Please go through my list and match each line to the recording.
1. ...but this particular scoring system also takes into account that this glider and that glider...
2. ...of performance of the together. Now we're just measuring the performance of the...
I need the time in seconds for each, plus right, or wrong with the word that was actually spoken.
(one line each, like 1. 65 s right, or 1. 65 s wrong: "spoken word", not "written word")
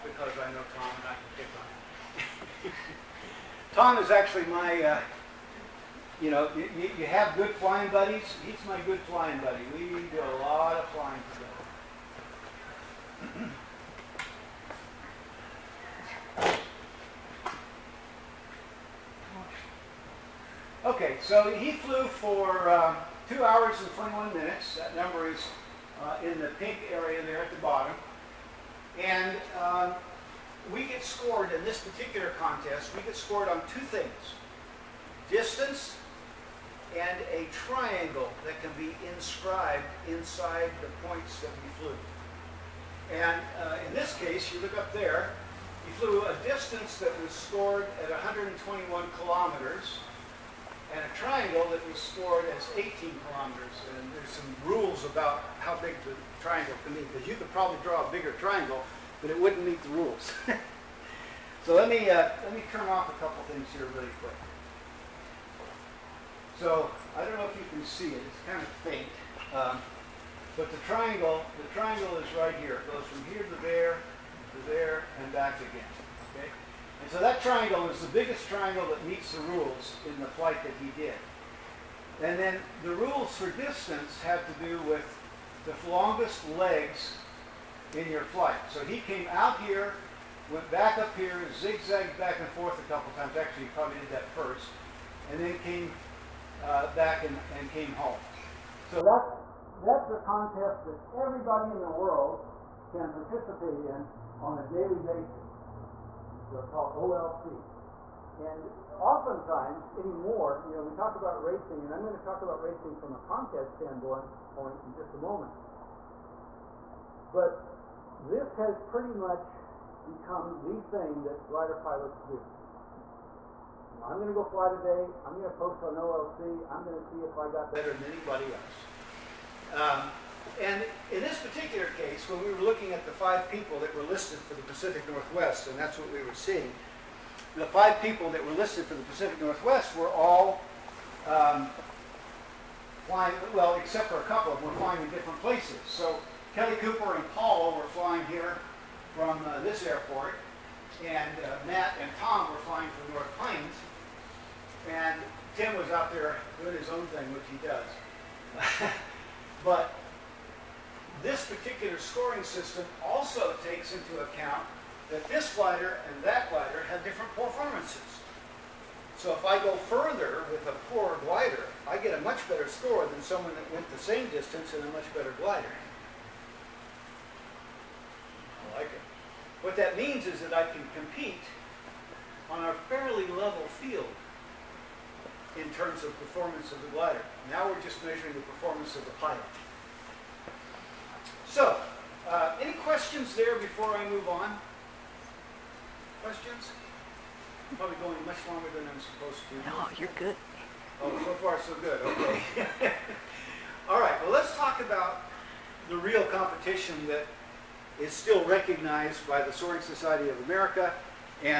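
1. 159 s right
2. 186 s wrong: "glider", not "together".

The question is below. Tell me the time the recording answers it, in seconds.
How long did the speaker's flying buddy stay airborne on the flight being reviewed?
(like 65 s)
23 s.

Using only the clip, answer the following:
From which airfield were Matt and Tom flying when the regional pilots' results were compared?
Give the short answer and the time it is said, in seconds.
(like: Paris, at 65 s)
North Plains, at 153 s.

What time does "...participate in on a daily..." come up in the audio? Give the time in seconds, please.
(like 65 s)
103 s.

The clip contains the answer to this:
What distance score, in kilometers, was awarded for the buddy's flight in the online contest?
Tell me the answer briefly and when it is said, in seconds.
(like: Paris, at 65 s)
121 kilometers, at 48 s.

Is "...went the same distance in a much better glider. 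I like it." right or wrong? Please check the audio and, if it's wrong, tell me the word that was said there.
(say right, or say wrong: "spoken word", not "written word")
right.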